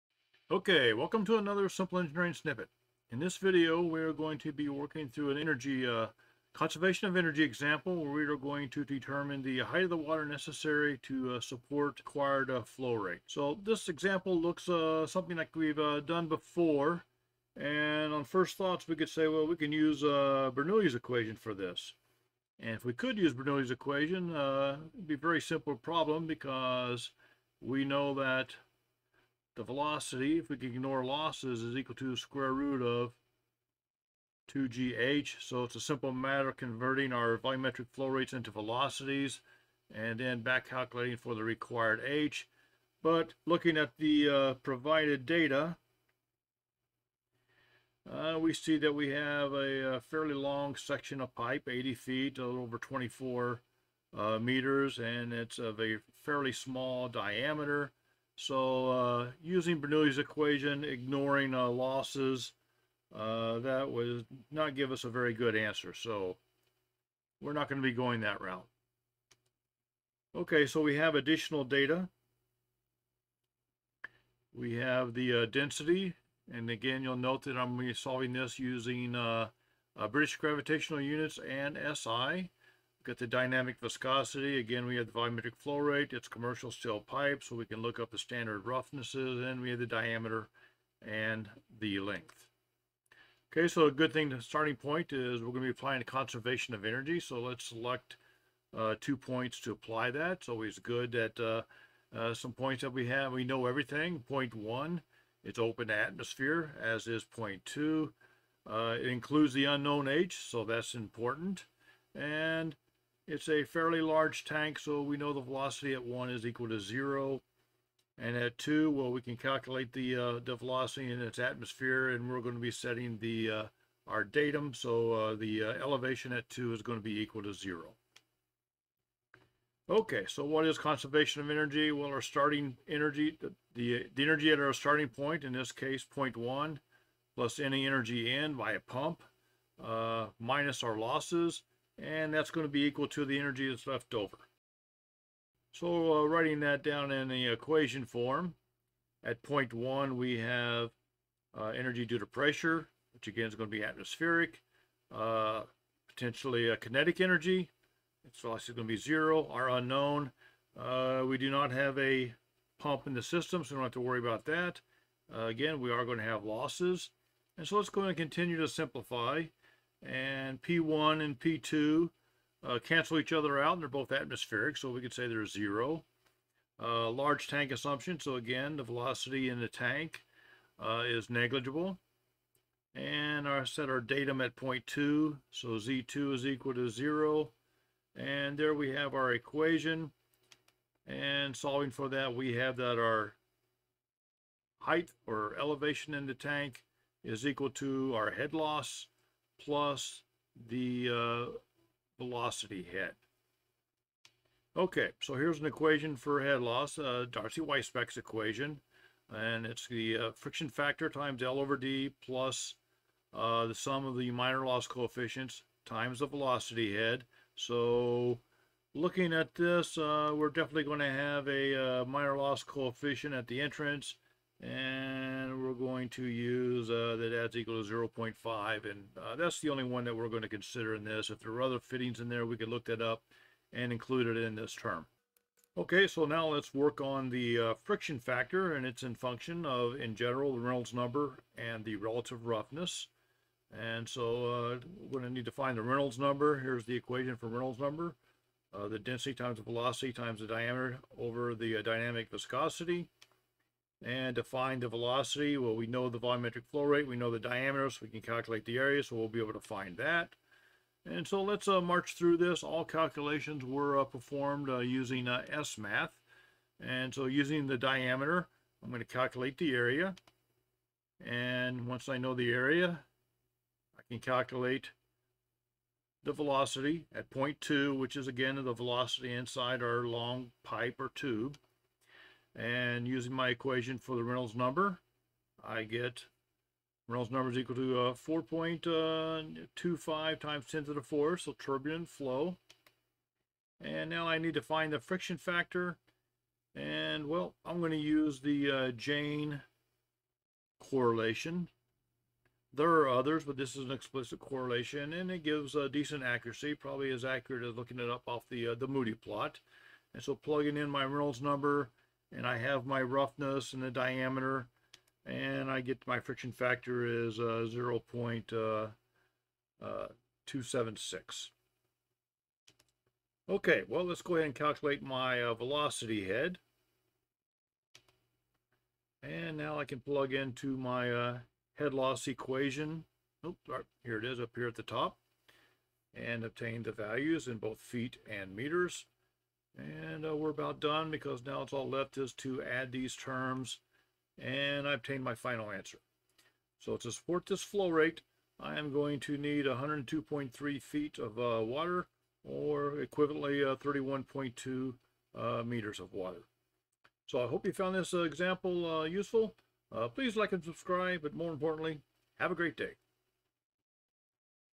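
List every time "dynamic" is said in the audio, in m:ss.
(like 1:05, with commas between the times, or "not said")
1:23, 4:11.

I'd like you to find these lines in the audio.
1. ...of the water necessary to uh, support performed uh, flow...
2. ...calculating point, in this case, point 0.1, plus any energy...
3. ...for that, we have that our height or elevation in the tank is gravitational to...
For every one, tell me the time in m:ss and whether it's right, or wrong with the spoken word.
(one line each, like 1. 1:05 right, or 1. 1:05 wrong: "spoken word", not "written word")
1. 0:09 wrong: "required", not "performed"
2. 2:14 wrong: "starting", not "calculating"
3. 3:11 wrong: "equal", not "gravitational".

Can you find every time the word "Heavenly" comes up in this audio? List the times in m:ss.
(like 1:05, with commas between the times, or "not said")
not said.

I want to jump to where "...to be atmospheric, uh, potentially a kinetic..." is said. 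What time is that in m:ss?
2:33.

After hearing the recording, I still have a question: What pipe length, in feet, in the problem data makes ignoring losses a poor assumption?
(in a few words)
80 feet.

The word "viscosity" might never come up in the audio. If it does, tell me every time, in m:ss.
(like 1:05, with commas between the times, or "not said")
1:23, 4:12.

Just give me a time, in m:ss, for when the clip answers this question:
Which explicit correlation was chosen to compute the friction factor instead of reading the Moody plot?
4:58.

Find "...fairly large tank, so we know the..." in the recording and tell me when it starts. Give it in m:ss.
1:53.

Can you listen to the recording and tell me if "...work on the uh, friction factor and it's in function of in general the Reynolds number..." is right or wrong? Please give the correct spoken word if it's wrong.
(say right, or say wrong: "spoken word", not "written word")
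right.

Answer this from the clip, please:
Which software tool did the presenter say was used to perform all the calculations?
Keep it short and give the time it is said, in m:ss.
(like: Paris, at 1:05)
SMath, at 4:25.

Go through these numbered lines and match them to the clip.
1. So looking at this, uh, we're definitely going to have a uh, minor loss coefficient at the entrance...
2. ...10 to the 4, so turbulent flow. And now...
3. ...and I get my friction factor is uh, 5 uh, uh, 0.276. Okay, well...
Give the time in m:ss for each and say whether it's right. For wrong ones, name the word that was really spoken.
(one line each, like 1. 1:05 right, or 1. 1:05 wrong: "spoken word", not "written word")
1. 3:37 right
2. 4:50 right
3. 5:15 wrong: "0", not "5".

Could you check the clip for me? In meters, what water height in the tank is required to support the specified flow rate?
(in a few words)
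31.2 meters.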